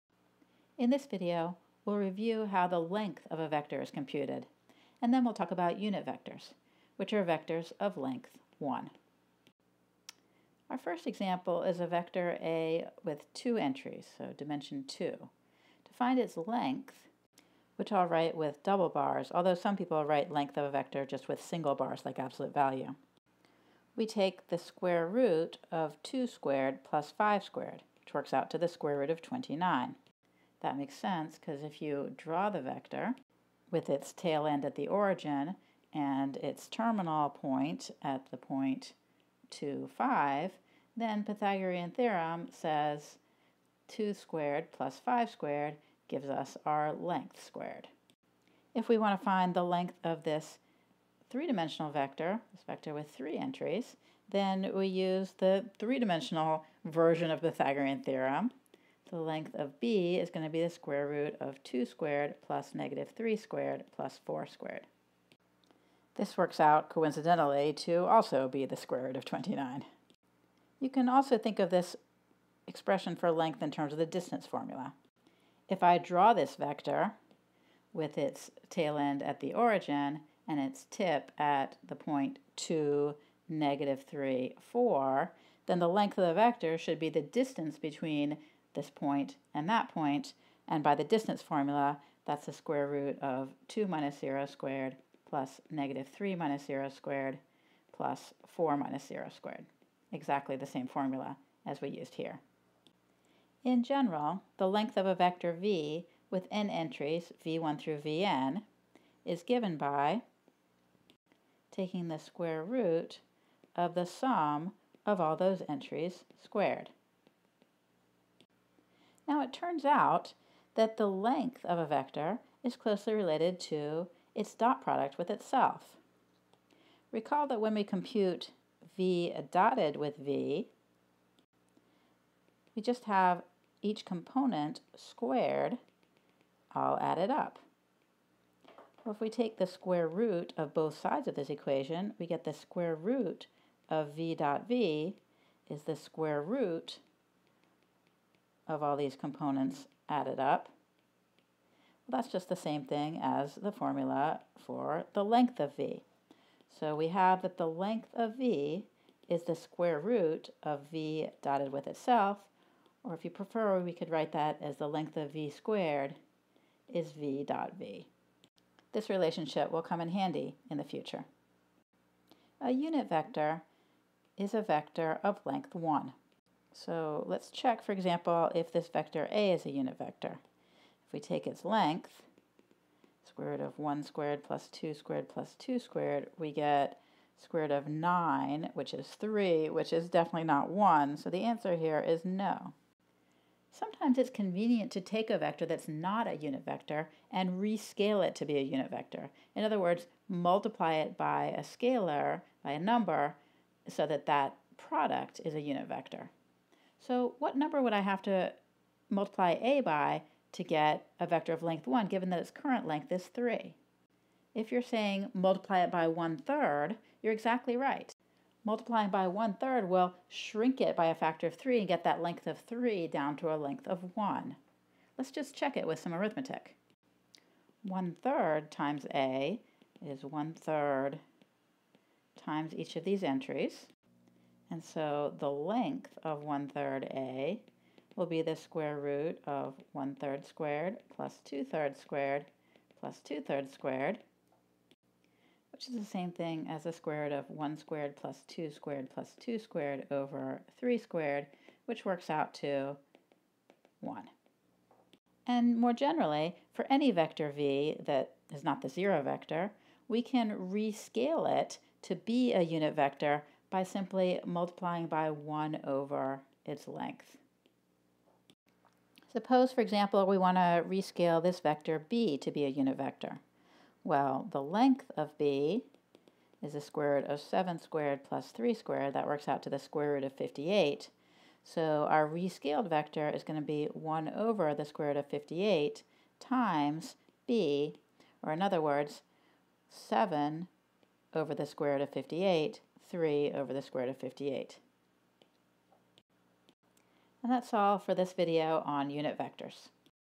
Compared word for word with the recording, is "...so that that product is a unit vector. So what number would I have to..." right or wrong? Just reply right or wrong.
right.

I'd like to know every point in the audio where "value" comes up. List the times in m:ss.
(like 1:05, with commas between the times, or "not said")
0:22.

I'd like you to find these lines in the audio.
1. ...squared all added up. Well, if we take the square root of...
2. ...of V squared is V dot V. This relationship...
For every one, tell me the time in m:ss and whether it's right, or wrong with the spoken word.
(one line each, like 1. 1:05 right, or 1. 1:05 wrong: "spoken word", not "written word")
1. 2:14 right
2. 2:45 right.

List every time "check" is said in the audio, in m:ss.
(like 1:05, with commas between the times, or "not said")
2:57, 3:45.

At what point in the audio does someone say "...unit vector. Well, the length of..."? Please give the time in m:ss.
4:32.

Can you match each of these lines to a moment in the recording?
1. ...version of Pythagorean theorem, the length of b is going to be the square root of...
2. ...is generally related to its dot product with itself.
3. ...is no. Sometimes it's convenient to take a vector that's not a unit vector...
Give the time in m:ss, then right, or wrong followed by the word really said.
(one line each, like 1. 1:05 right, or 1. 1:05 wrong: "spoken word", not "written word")
1. 0:56 right
2. 2:02 wrong: "closely", not "generally"
3. 3:11 right.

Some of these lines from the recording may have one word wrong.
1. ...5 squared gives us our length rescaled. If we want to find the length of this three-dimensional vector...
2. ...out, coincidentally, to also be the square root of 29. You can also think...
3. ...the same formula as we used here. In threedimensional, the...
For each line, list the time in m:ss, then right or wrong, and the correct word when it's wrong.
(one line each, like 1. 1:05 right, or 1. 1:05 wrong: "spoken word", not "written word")
1. 0:44 wrong: "squared", not "rescaled"
2. 1:06 right
3. 1:40 wrong: "general", not "threedimensional".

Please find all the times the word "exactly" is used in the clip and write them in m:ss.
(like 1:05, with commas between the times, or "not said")
1:40, 3:37.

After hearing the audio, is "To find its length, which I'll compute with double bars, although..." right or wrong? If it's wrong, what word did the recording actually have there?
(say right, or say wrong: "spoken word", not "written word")
wrong: "write", not "compute".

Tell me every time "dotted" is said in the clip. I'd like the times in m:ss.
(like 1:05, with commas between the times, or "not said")
2:09, 2:41.